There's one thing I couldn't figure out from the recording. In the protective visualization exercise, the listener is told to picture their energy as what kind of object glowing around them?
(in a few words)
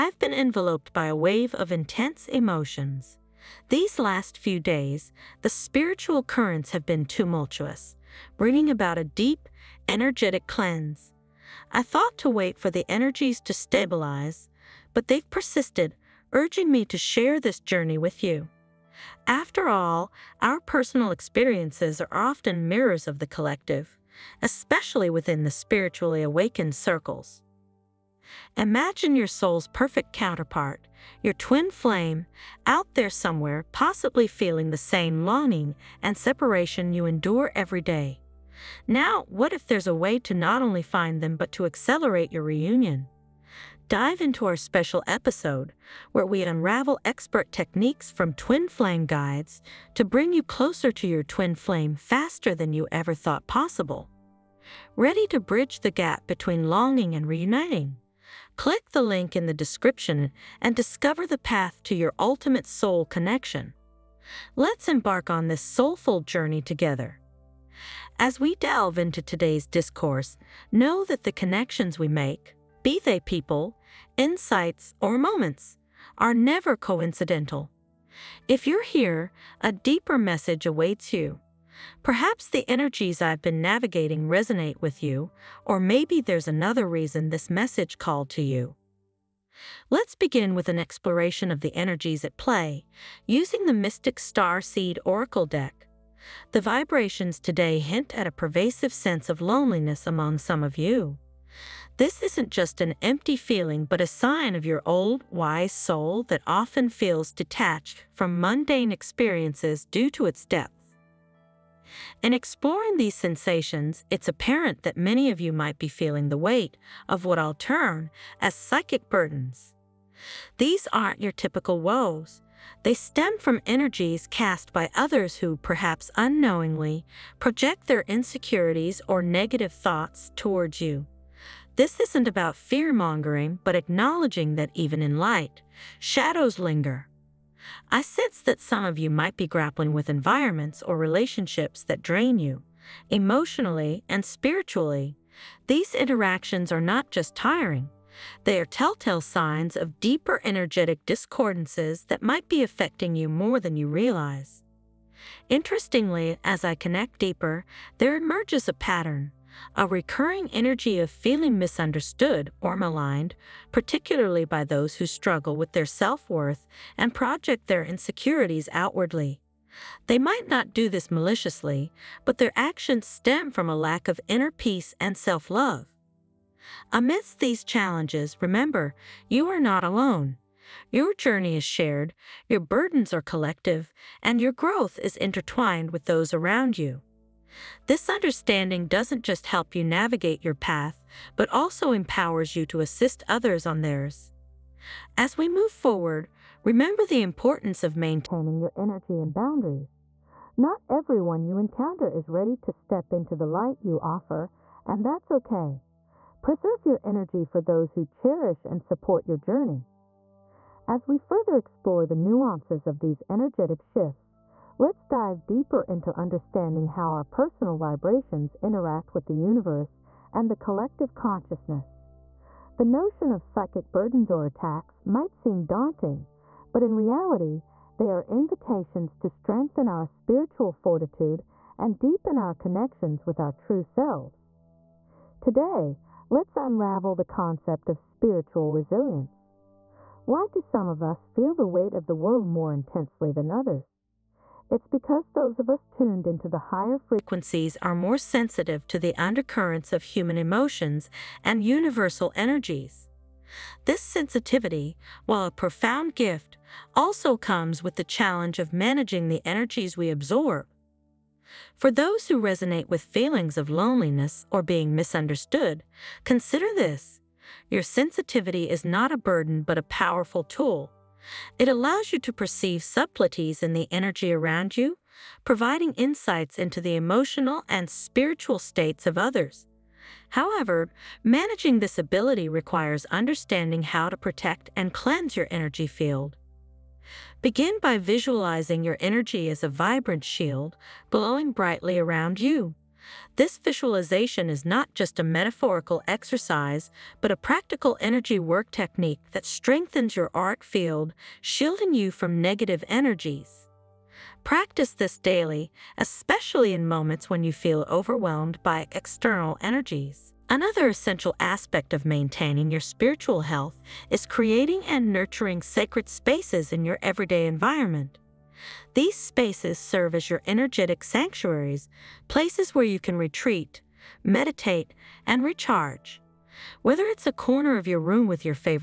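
a vibrant shield.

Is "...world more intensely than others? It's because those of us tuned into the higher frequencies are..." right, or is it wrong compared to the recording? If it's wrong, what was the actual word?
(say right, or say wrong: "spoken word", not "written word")
right.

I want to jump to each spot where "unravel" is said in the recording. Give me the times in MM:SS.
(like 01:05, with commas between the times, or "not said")
00:46, 03:56.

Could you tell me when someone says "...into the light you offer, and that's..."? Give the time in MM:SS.
03:23.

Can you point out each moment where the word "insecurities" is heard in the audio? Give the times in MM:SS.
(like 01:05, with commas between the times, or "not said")
02:08, 02:47.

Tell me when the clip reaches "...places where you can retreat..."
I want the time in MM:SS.
05:22.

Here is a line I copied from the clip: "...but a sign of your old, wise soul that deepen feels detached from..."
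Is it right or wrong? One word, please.
wrong.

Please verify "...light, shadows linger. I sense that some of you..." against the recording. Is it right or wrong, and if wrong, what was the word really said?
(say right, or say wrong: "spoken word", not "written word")
right.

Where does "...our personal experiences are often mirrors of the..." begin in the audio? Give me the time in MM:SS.
00:20.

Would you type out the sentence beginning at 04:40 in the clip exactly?
However, managing this ability requires understanding how to protect and cleanse your energy field.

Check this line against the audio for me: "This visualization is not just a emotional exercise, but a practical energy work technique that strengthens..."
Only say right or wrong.
wrong.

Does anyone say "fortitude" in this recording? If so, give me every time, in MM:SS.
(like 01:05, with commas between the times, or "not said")
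03:50.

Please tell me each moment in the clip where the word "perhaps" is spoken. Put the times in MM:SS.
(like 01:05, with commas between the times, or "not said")
01:22, 02:05.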